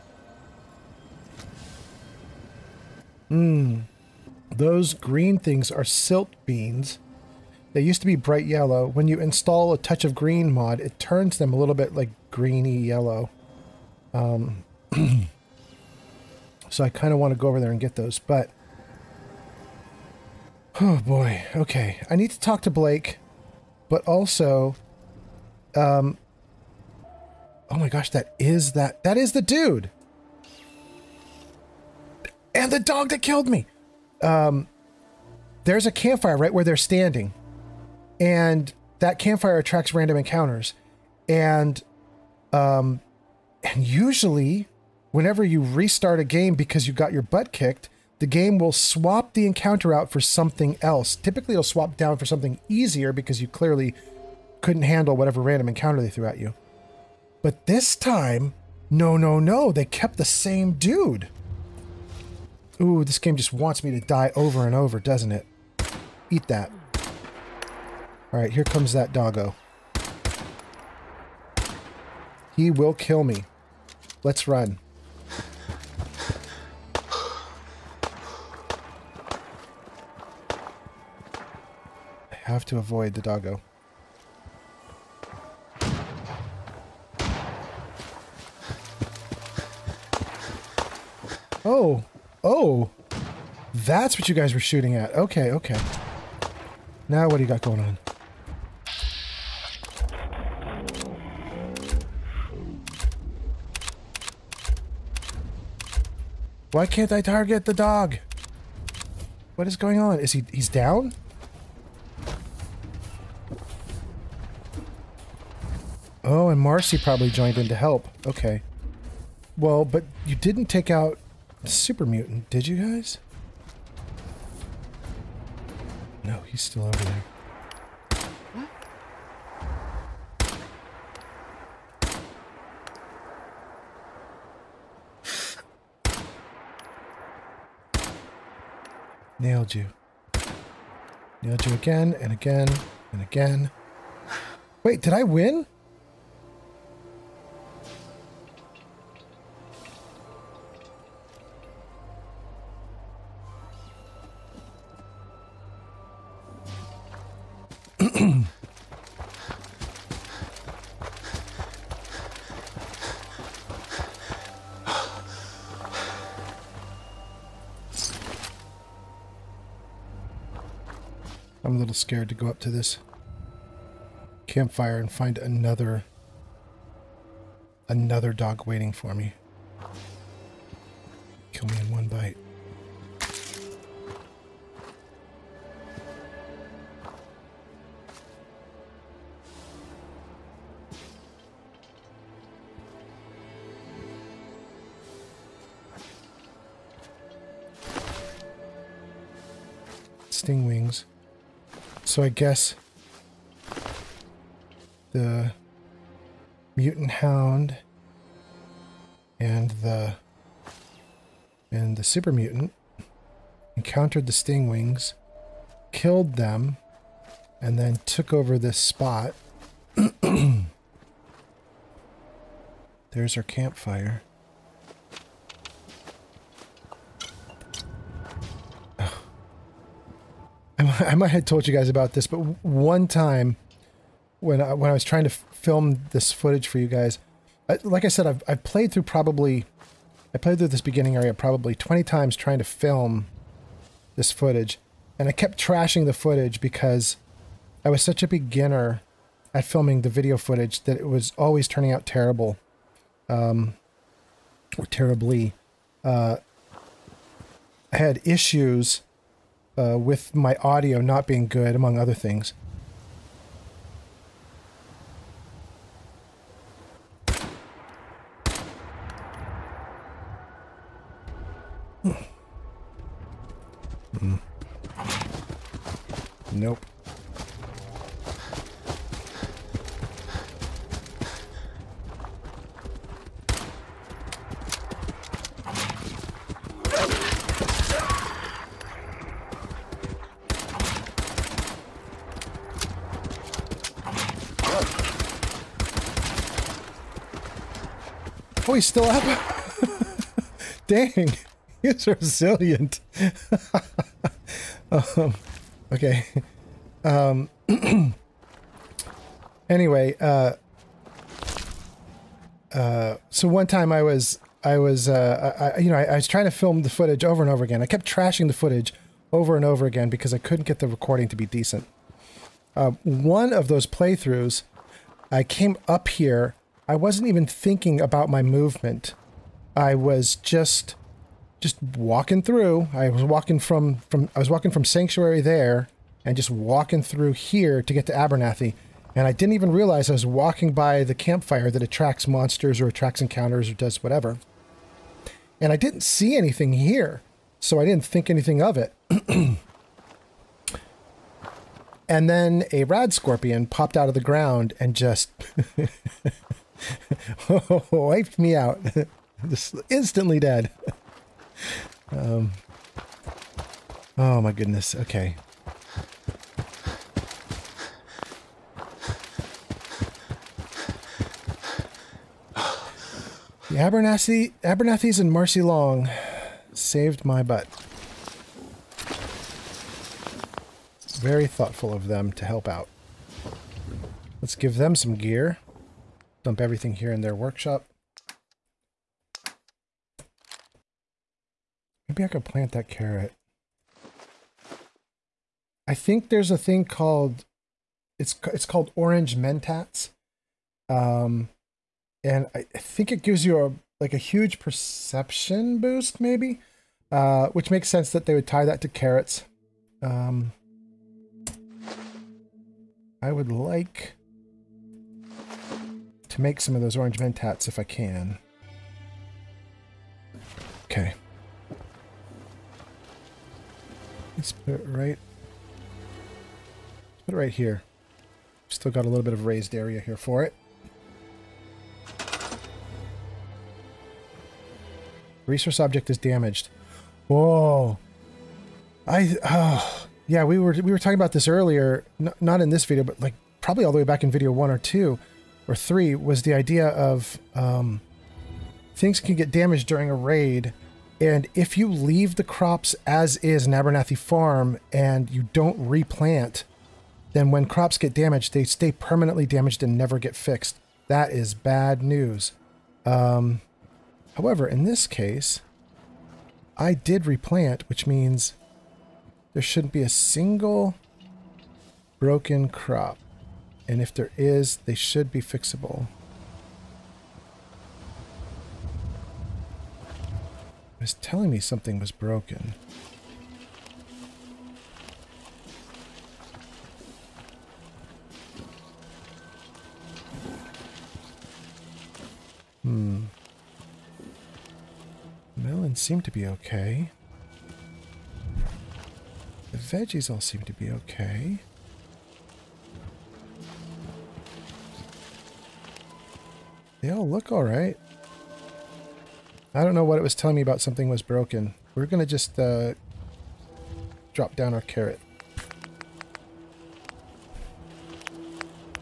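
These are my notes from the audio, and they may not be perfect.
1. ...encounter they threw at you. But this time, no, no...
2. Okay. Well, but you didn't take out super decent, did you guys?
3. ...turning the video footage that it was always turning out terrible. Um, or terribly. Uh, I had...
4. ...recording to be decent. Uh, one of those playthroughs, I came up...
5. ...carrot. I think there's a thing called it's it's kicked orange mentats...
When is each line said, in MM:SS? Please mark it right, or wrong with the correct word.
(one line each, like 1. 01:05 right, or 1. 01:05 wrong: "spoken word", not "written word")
1. 00:55 right
2. 01:58 wrong: "mutant", not "decent"
3. 04:09 wrong: "filming", not "turning"
4. 05:20 right
5. 06:32 wrong: "called", not "kicked".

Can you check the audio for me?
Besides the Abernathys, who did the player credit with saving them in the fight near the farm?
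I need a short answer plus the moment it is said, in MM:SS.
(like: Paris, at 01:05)
Marcy Long, at 06:15.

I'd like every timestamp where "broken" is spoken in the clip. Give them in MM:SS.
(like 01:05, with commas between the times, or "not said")
07:52, 08:02, 08:31.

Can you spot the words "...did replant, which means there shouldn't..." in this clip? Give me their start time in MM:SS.
07:46.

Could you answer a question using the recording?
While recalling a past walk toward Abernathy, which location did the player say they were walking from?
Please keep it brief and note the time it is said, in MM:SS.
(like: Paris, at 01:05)
Sanctuary, at 05:34.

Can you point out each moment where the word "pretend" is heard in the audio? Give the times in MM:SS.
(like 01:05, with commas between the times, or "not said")
not said.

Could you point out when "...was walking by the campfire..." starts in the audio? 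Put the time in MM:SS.
05:40.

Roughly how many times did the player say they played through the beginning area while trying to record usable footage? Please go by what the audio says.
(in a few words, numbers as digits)
20.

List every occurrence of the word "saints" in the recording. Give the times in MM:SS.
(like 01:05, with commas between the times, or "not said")
not said.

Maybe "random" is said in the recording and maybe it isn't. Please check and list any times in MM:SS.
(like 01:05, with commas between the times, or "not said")
00:39, 00:55.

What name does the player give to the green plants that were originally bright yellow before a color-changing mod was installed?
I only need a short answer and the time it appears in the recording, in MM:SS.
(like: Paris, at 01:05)
silt beans, at 00:05.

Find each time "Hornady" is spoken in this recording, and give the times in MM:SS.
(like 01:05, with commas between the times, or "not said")
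not said.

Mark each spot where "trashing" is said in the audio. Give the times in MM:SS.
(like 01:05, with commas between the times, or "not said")
04:05, 05:18.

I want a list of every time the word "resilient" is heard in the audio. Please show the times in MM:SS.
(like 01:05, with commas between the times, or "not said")
05:02.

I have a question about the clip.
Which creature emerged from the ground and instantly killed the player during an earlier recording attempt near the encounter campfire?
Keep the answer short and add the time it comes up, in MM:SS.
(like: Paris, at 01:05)
rad scorpion, at 05:52.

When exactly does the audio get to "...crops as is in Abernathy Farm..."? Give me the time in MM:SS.
07:32.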